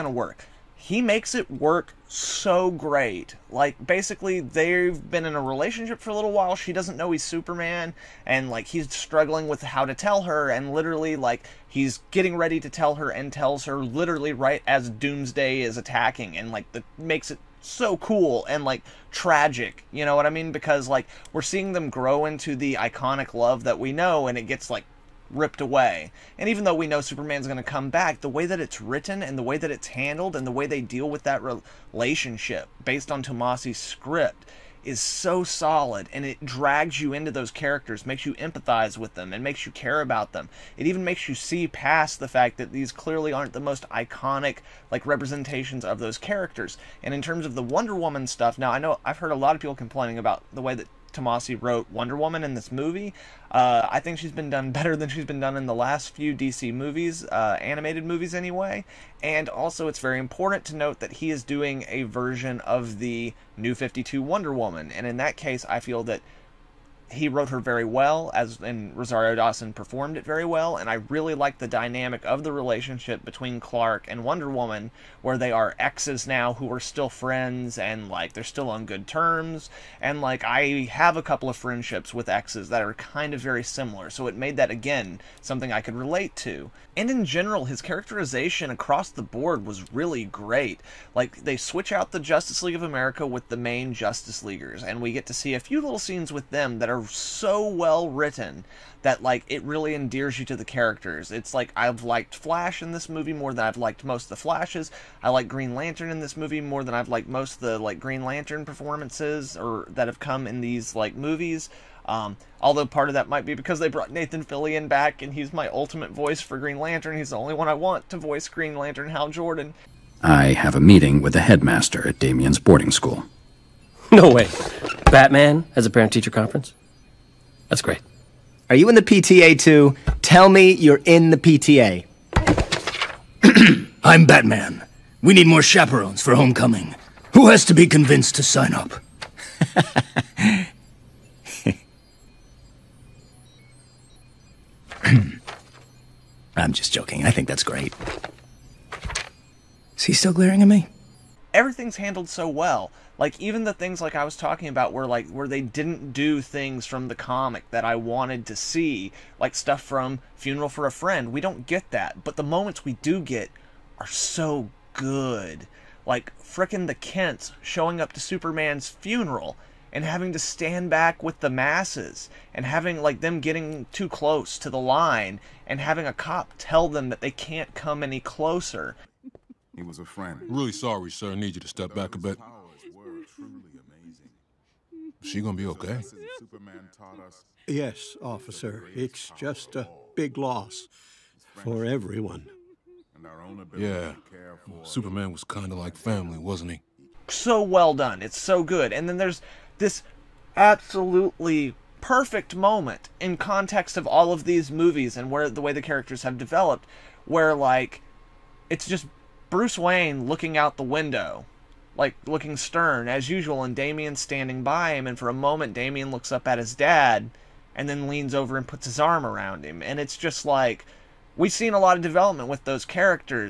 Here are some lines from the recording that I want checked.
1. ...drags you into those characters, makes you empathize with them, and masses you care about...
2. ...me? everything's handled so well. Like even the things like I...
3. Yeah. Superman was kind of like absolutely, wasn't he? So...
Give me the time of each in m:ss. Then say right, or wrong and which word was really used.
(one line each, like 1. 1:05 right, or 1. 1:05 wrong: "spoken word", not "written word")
1. 0:36 wrong: "makes", not "masses"
2. 2:30 right
3. 3:13 wrong: "family", not "absolutely".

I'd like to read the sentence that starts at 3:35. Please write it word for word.
And for a moment, Damian looks up at his dad and then leans over and puts his arm around him.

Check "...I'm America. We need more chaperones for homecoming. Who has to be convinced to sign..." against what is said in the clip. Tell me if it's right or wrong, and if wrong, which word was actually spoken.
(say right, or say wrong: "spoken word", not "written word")
wrong: "Batman", not "America".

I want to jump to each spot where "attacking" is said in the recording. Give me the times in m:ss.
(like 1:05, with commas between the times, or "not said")
0:15.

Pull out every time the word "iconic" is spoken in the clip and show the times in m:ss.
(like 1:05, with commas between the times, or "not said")
0:22, 0:43.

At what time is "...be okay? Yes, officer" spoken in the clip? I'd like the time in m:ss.
3:05.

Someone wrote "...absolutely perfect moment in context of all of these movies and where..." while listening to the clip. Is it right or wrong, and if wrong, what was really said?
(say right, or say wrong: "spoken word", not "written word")
right.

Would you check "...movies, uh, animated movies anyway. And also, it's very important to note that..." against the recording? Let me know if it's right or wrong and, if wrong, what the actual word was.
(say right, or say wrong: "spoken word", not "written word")
right.